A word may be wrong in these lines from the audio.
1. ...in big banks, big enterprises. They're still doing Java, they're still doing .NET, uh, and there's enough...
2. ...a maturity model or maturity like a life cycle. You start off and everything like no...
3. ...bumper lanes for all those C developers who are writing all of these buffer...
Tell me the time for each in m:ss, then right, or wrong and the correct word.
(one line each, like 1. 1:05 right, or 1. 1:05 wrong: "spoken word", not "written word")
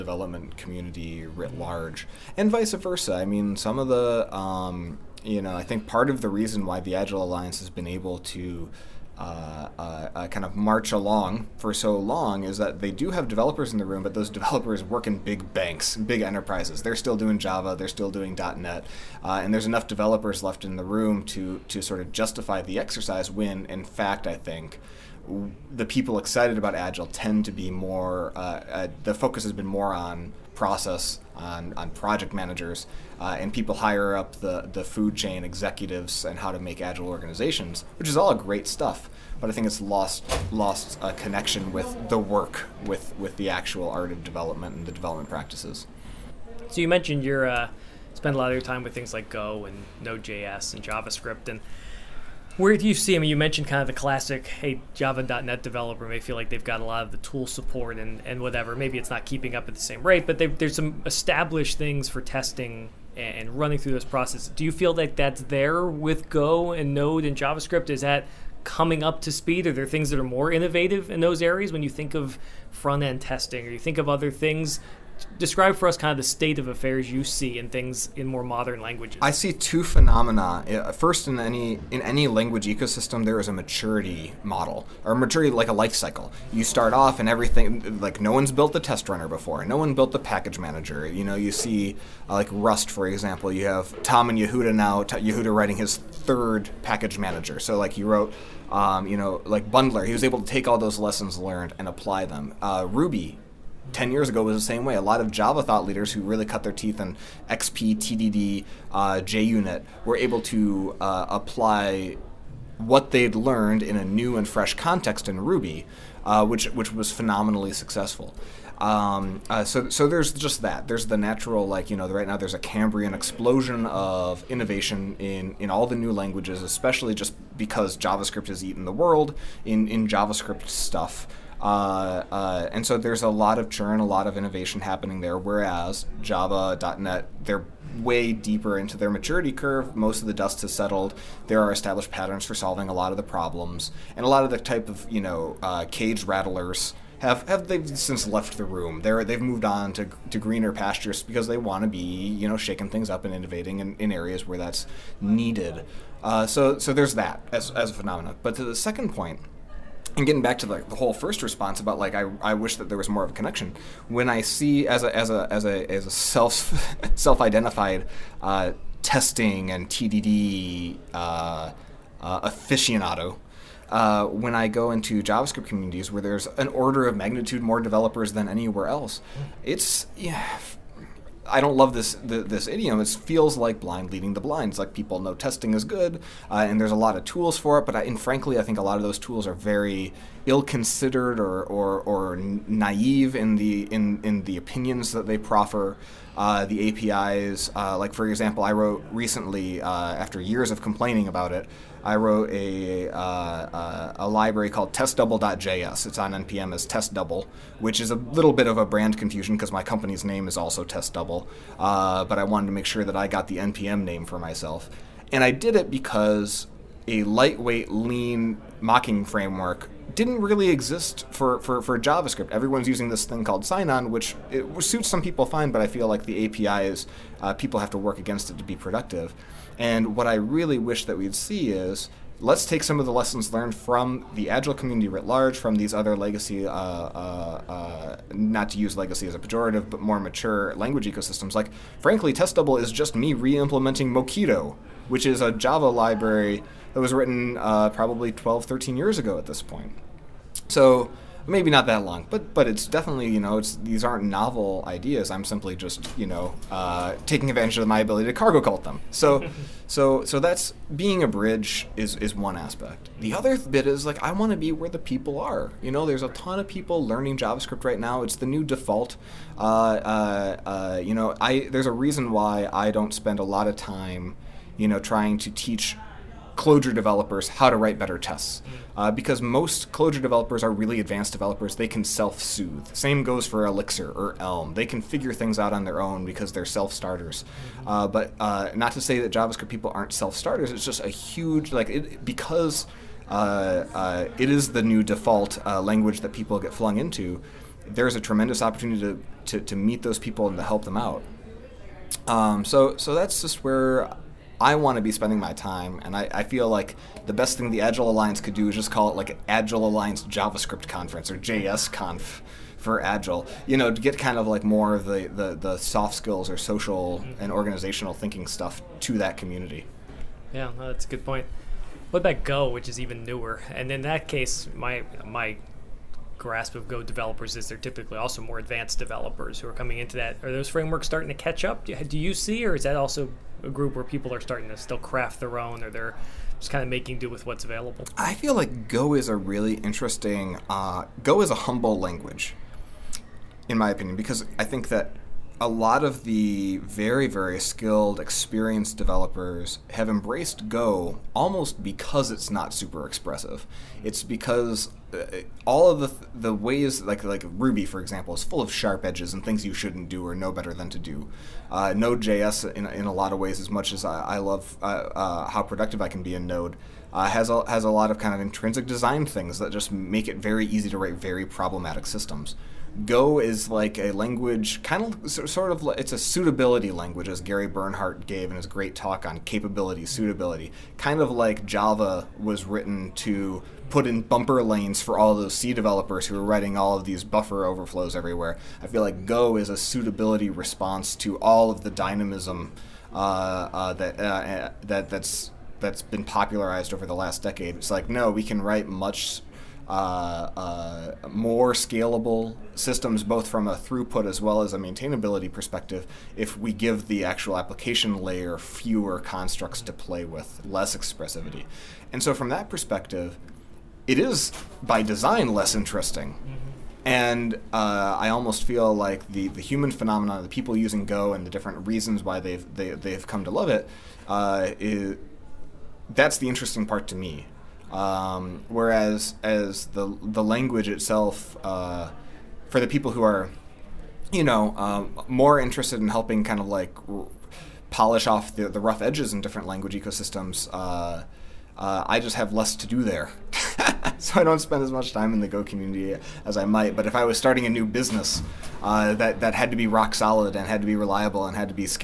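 1. 0:15 right
2. 1:23 right
3. 6:24 right.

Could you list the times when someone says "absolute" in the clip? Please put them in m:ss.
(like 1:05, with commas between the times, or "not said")
not said.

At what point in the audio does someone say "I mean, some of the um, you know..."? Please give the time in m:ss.
0:03.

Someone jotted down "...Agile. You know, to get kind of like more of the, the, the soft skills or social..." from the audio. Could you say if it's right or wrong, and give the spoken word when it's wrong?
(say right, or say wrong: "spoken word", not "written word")
right.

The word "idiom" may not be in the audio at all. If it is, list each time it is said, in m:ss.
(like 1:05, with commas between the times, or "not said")
3:02.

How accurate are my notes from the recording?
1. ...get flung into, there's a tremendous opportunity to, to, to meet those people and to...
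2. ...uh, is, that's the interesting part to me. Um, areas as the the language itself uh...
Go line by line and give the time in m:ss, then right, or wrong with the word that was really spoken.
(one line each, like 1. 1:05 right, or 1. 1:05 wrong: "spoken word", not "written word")
1. 4:56 right
2. 7:04 wrong: "whereas", not "areas".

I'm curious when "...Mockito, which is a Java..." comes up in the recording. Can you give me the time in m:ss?
4:04.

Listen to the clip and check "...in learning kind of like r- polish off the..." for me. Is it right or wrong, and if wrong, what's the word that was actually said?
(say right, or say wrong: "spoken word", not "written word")
wrong: "helping", not "learning".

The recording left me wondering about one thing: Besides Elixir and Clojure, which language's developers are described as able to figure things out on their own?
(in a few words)
Elm.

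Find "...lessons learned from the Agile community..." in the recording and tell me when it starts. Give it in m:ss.
3:53.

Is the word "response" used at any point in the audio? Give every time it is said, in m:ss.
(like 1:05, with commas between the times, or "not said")
2:41, 6:30.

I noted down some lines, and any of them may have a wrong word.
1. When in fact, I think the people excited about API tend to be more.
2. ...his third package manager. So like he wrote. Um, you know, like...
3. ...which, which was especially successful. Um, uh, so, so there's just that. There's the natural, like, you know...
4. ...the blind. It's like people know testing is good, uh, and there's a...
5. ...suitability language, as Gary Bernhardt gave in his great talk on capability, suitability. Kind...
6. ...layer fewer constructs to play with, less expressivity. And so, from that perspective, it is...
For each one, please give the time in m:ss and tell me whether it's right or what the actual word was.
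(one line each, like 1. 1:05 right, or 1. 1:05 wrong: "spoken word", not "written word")
1. 0:23 wrong: "Agile", not "API"
2. 1:35 right
3. 1:56 wrong: "phenomenally", not "especially"
4. 3:04 right
5. 6:16 right
6. 6:48 right.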